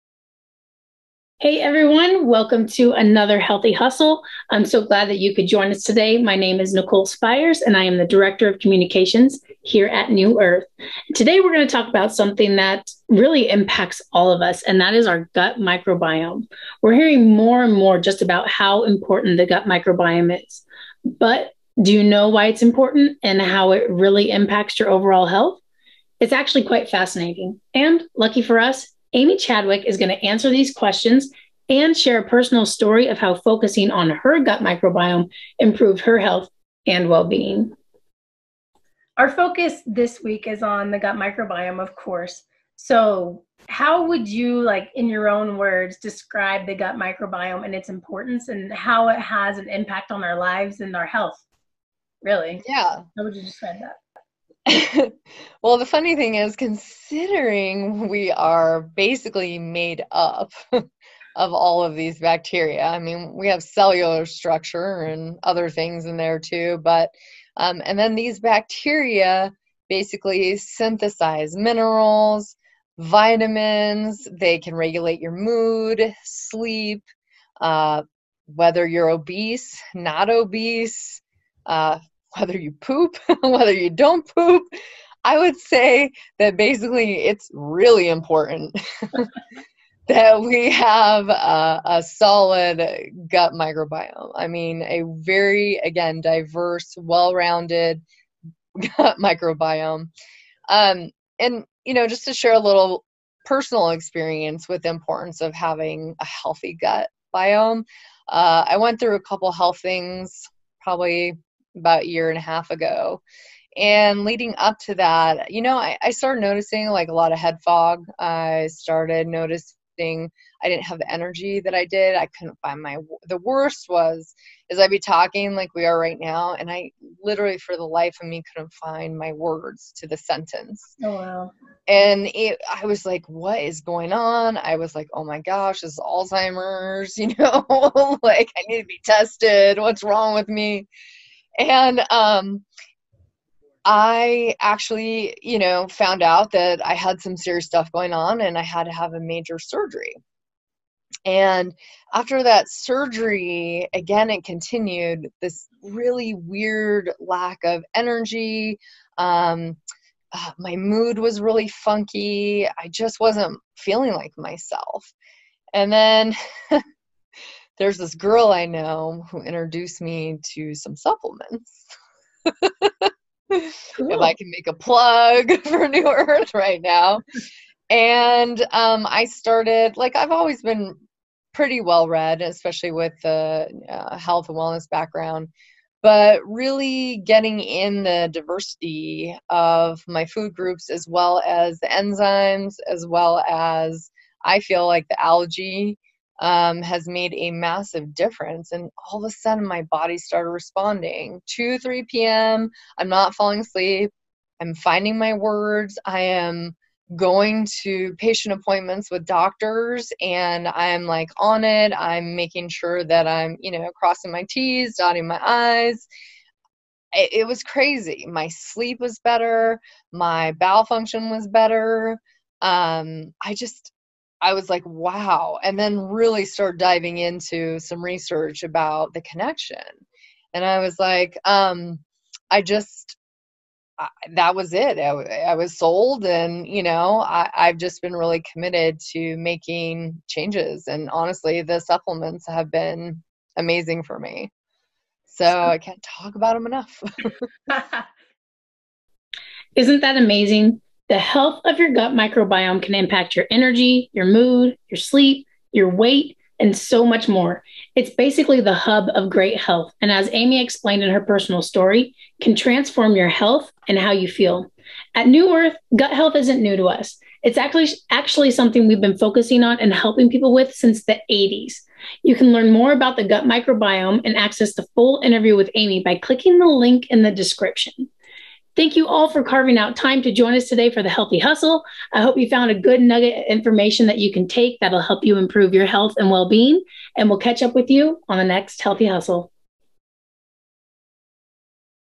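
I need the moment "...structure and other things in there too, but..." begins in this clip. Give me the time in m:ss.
1:04.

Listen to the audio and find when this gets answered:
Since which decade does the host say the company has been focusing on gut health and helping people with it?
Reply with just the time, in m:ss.
4:31.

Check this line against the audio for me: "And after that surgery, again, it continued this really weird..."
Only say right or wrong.
right.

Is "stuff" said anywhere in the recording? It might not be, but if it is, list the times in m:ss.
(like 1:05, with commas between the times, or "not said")
2:27.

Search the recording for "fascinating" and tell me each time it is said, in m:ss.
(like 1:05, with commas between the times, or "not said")
0:26.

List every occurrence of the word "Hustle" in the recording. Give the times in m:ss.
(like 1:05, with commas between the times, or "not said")
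0:03, 4:41, 4:49.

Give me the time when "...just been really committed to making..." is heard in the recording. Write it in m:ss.
3:57.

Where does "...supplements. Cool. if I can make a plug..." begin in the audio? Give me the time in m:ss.
2:50.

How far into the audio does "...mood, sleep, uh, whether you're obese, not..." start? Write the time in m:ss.
1:15.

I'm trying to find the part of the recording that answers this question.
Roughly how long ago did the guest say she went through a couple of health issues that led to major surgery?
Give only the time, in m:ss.
1:52.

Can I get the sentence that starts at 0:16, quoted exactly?
We're hearing more and more just about how important the gut microbiome is.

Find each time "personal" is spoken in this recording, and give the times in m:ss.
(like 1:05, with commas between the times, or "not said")
0:32, 1:43, 4:21.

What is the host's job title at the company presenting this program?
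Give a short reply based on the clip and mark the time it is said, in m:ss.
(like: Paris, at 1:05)
Director of Communications, at 0:08.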